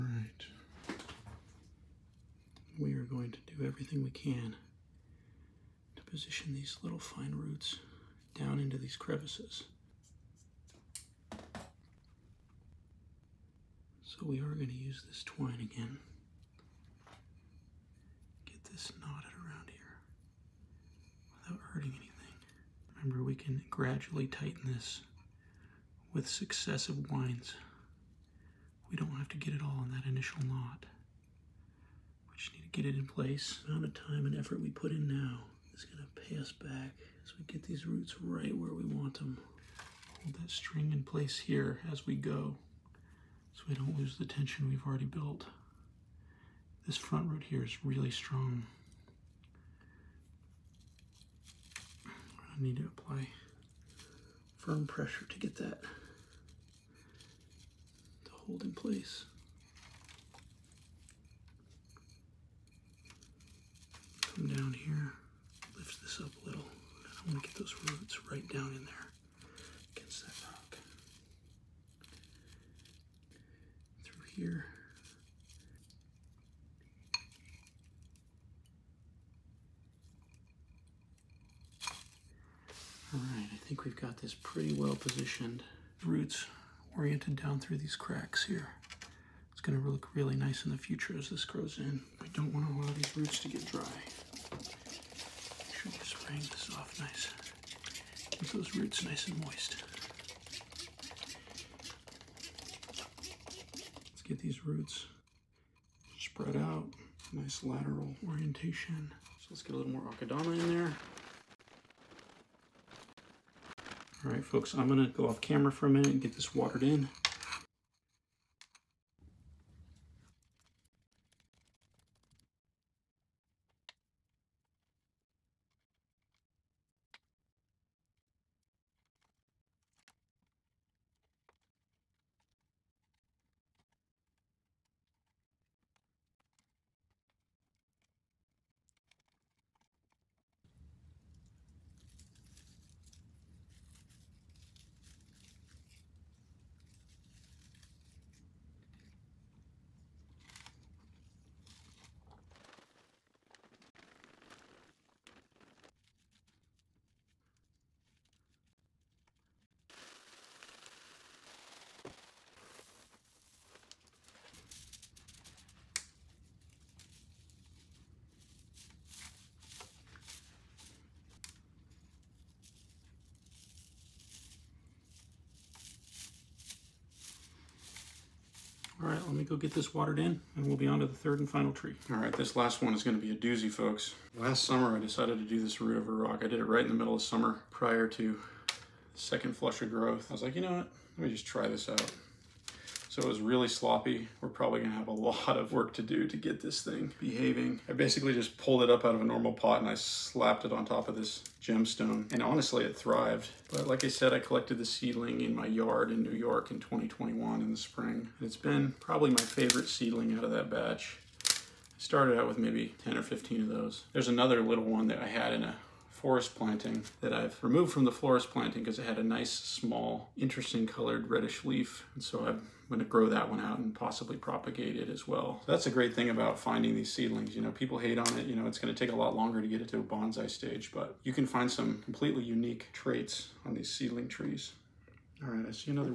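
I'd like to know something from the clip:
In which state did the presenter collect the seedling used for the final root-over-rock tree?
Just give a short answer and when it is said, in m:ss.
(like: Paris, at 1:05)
New York, at 3:26.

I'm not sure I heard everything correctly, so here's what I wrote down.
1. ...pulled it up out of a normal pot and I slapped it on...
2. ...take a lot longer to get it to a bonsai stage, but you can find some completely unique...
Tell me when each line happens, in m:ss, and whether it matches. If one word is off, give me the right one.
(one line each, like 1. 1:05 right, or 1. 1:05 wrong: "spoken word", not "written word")
1. 3:18 right
2. 3:48 right.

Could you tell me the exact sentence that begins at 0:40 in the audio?
Hold that string in place here as we go we don't lose the tension we've already built.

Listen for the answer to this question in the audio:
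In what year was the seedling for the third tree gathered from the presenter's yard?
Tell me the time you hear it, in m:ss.
3:26.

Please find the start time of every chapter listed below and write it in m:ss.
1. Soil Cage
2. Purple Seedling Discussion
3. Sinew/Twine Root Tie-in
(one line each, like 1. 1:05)
1. 2:00
2. 3:01
3. 0:14.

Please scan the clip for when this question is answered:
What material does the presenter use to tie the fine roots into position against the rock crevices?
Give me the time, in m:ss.
0:15.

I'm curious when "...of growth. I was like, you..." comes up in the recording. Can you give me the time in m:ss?
3:09.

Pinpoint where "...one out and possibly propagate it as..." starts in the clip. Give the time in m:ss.
3:43.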